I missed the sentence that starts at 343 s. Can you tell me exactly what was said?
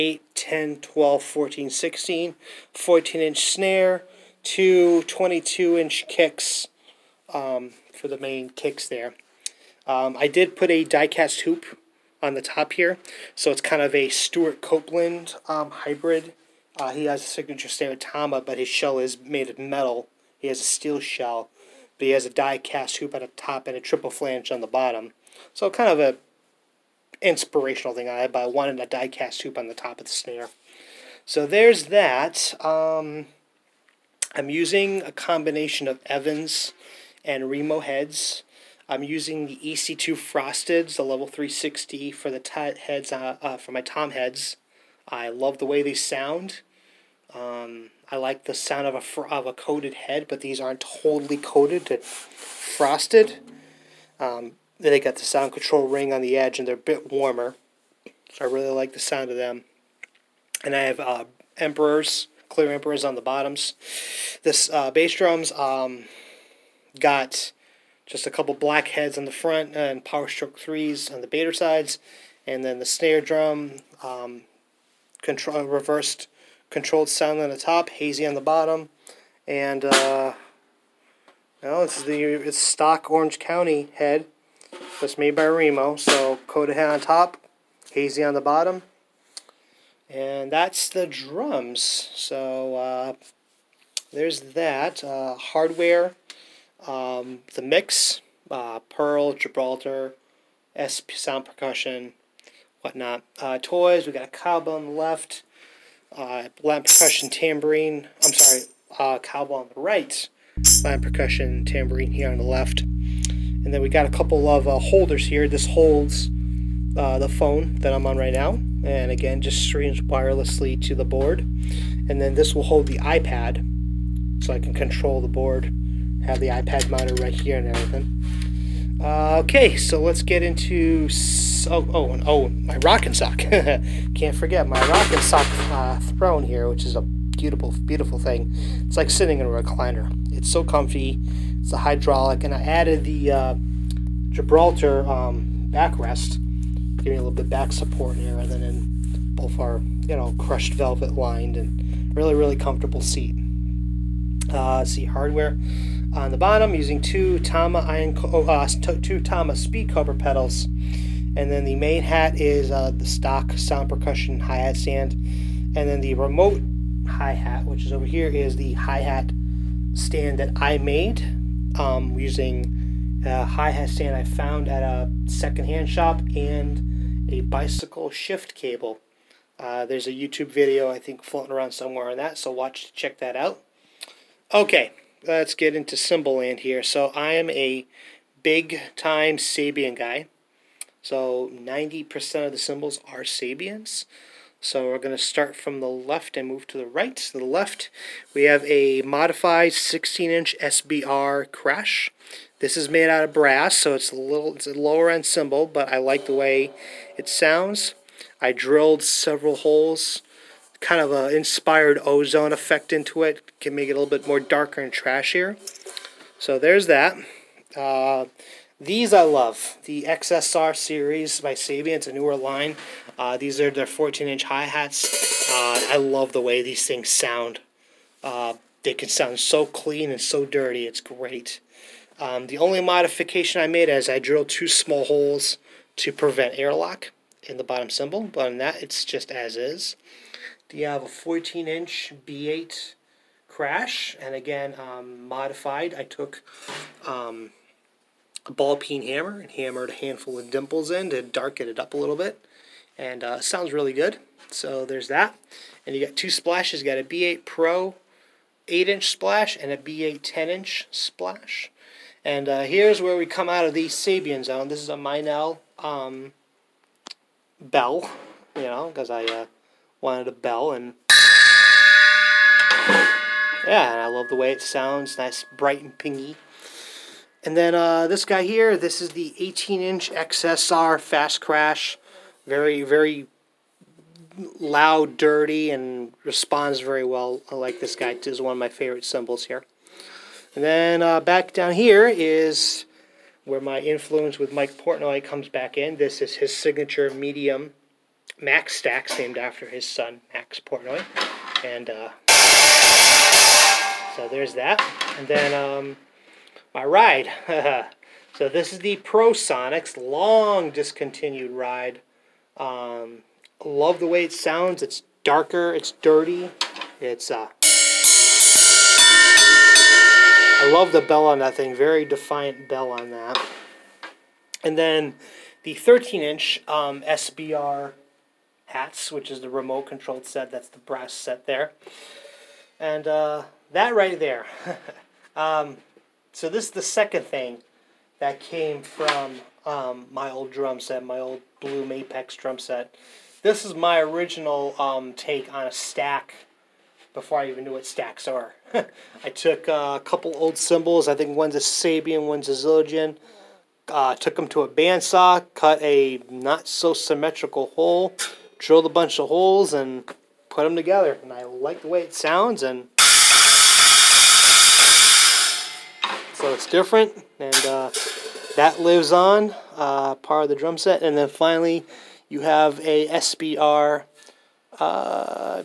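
This is my original um, take on a stack before I even knew what stacks are.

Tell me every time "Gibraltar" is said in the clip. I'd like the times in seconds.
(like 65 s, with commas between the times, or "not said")
99 s, 144 s.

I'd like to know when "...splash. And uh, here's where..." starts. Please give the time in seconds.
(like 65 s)
260 s.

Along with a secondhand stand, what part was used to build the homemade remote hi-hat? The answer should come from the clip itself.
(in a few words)
bicycle shift cable.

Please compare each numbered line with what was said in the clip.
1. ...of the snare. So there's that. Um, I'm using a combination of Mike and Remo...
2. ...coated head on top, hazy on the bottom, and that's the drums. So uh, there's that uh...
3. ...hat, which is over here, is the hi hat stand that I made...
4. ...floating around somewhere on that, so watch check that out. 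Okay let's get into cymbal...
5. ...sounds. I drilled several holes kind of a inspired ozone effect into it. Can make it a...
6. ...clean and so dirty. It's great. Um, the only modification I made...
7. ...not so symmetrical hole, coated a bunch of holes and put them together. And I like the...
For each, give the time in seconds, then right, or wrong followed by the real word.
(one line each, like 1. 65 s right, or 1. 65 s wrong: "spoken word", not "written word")
1. 29 s wrong: "Evans", not "Mike"
2. 86 s right
3. 167 s right
4. 181 s right
5. 207 s right
6. 229 s right
7. 356 s wrong: "drilled", not "coated".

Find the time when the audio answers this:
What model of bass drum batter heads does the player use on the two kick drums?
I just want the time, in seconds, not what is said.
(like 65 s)
70 s.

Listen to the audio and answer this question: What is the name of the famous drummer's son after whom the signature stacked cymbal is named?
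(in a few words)
Max Portnoy.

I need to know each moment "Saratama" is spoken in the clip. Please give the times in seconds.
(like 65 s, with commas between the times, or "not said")
17 s.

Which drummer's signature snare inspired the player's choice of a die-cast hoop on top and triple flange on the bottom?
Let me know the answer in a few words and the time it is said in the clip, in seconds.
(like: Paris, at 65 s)
Stewart Copeland, at 14 s.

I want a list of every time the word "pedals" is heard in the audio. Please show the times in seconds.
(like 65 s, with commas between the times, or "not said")
160 s.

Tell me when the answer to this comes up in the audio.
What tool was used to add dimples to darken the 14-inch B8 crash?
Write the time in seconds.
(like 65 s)
248 s.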